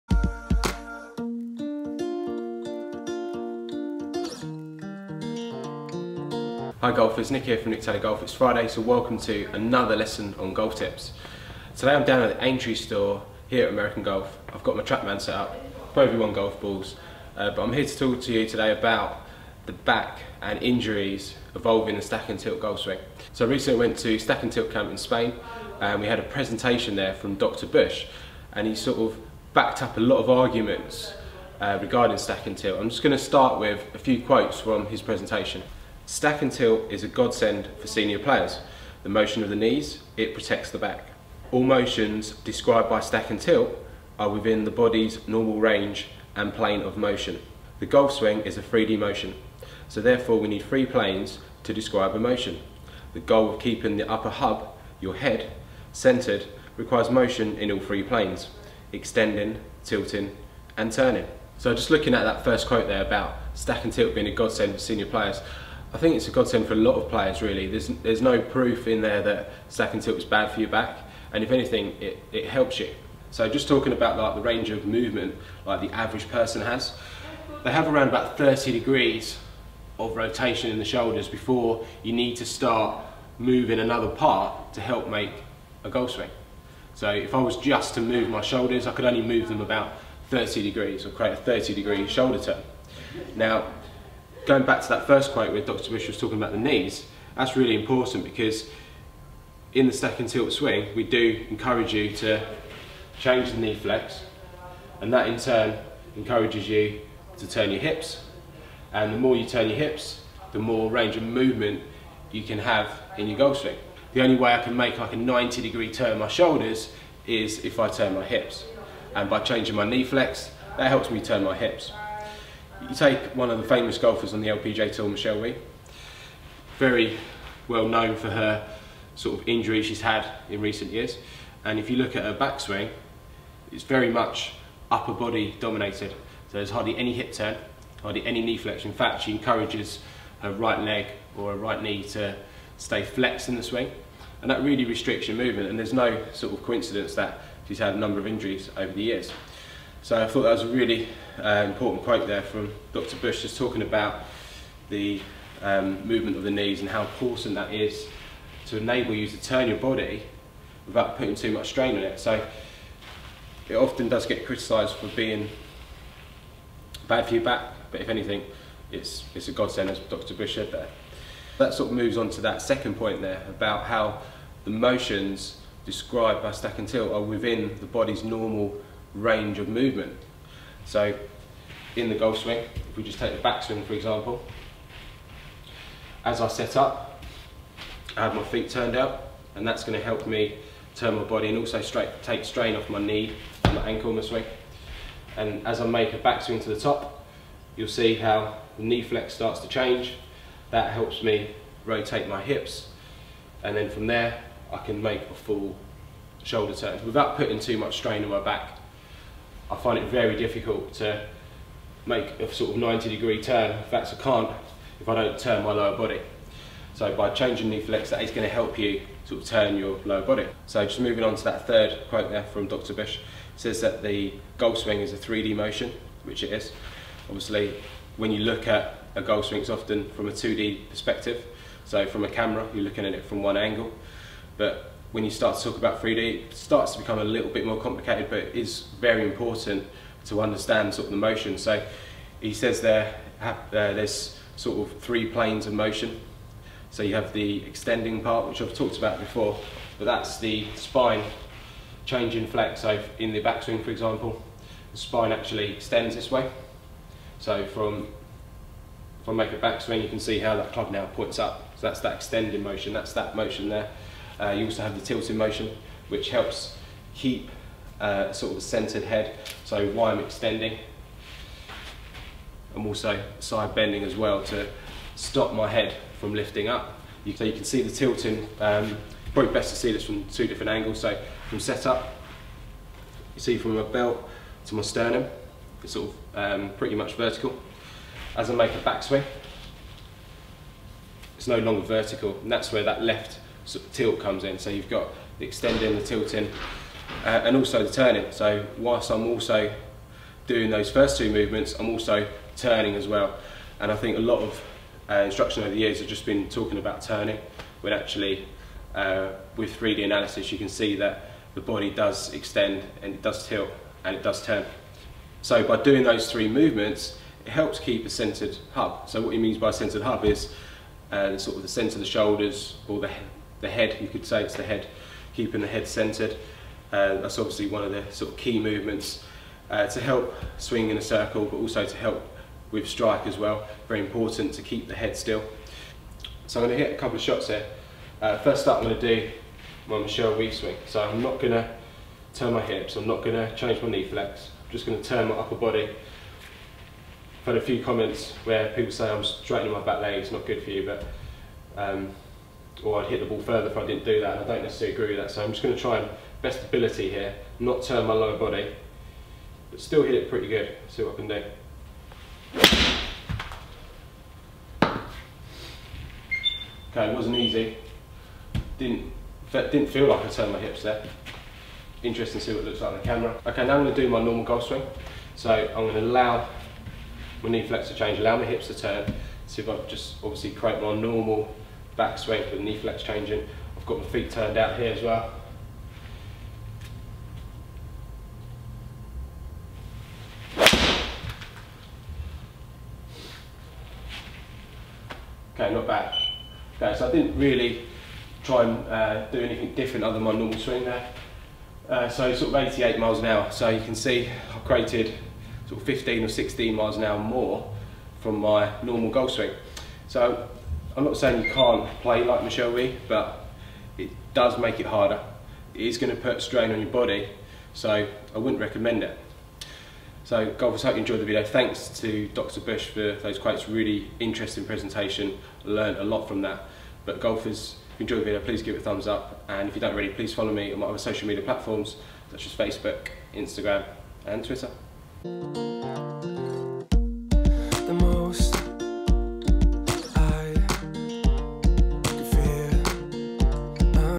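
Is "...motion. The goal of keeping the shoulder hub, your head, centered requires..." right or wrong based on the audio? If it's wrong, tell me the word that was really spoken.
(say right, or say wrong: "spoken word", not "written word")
wrong: "upper", not "shoulder".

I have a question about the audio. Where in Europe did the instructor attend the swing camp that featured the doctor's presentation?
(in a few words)
Spain.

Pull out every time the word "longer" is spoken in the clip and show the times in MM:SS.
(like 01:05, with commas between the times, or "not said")
04:51.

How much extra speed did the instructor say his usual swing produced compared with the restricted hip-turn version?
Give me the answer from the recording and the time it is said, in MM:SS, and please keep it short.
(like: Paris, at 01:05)
15 or 16 mph, at 06:45.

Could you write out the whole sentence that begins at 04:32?
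I'm also side bending as well to stop my head from lifting up.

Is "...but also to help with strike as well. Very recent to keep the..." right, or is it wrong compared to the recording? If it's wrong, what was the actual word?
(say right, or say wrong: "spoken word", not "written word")
wrong: "important", not "recent".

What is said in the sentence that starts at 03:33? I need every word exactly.
In fact, I can't if I don't turn my lower body.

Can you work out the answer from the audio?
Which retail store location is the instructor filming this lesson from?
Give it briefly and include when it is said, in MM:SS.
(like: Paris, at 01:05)
Aintree, at 00:12.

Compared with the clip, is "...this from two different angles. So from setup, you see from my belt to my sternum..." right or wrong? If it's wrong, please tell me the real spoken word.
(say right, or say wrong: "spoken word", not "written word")
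right.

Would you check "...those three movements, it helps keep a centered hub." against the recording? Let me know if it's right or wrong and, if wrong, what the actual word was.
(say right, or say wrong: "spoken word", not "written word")
right.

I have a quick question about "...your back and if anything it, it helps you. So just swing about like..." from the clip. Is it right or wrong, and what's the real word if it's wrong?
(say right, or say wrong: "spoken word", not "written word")
wrong: "talking", not "swing".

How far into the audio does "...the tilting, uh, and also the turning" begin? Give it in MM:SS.
04:55.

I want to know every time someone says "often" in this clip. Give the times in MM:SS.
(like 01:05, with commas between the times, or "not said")
02:43, 03:49.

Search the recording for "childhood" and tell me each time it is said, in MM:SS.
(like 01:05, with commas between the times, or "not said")
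not said.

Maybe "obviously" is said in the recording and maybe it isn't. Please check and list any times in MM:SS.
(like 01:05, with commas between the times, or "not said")
03:47, 05:27, 06:20.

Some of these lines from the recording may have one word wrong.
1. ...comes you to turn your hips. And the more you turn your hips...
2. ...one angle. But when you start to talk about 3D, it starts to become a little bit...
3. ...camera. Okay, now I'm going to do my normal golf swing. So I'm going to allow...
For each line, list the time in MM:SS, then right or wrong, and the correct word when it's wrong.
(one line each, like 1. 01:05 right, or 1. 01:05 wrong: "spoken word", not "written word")
1. 01:46 wrong: "encourages", not "comes"
2. 03:53 right
3. 06:13 right.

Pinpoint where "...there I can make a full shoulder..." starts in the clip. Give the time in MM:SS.
03:24.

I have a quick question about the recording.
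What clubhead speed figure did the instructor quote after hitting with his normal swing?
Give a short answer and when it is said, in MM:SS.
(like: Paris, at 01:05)
88 mph, at 06:42.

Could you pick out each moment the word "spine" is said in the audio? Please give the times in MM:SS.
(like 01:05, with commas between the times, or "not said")
04:10, 04:14.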